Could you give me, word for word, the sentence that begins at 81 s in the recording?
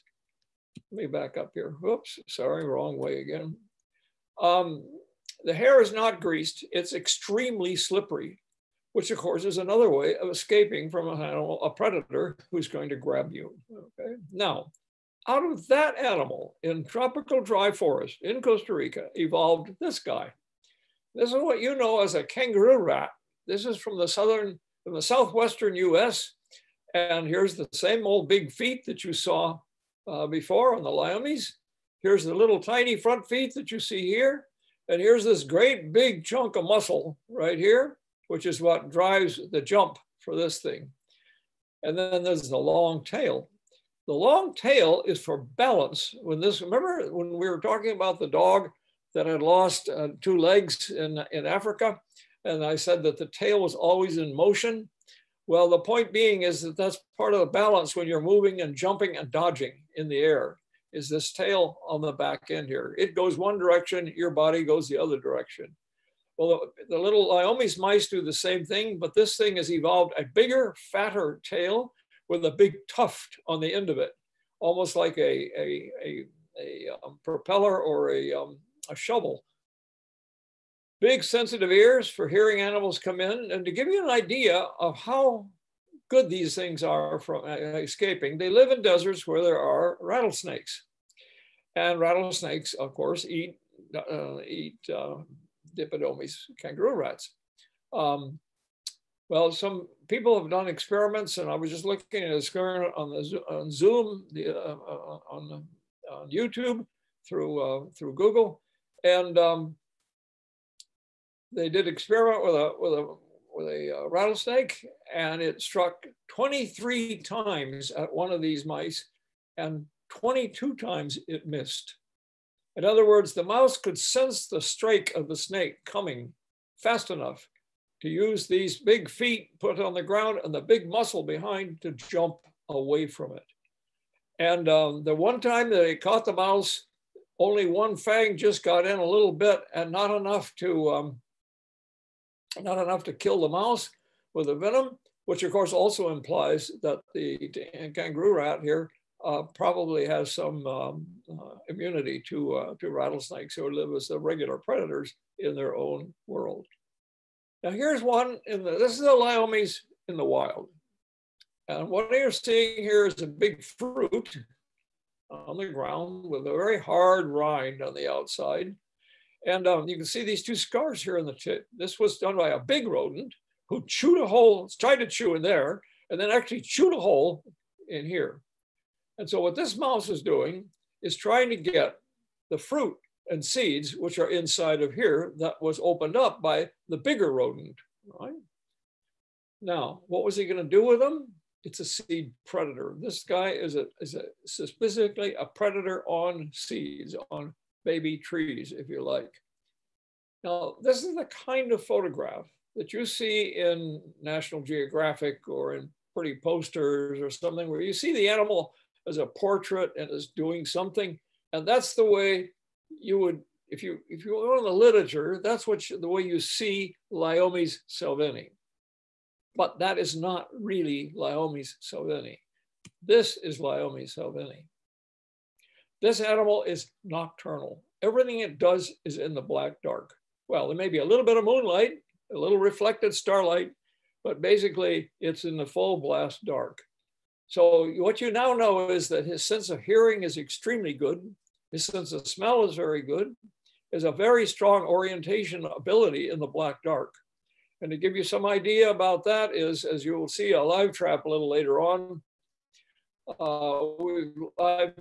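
Big sensitive ears for hearing animals come in.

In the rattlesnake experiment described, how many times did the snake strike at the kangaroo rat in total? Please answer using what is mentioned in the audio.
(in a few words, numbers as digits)
23.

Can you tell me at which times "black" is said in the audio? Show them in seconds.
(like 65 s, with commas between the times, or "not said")
229 s, 246 s.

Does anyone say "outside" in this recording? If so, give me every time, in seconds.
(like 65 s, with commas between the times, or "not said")
168 s.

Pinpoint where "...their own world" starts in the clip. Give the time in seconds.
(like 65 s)
155 s.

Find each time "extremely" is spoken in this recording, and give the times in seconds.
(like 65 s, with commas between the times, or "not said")
6 s, 240 s.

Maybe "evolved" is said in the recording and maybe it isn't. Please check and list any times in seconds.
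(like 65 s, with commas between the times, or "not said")
19 s, 69 s.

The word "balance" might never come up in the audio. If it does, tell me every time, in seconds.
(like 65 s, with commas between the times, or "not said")
45 s, 57 s.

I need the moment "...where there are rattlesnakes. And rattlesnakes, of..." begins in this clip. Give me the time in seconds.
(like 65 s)
89 s.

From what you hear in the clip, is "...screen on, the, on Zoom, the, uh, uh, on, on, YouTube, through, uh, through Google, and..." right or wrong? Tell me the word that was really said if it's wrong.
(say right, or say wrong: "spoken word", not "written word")
right.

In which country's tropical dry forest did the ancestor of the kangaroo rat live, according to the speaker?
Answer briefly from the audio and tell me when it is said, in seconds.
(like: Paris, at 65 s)
Costa Rica, at 18 s.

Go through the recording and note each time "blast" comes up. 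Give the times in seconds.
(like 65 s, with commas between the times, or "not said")
235 s.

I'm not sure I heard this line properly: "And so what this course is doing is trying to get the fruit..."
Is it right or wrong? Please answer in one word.
wrong.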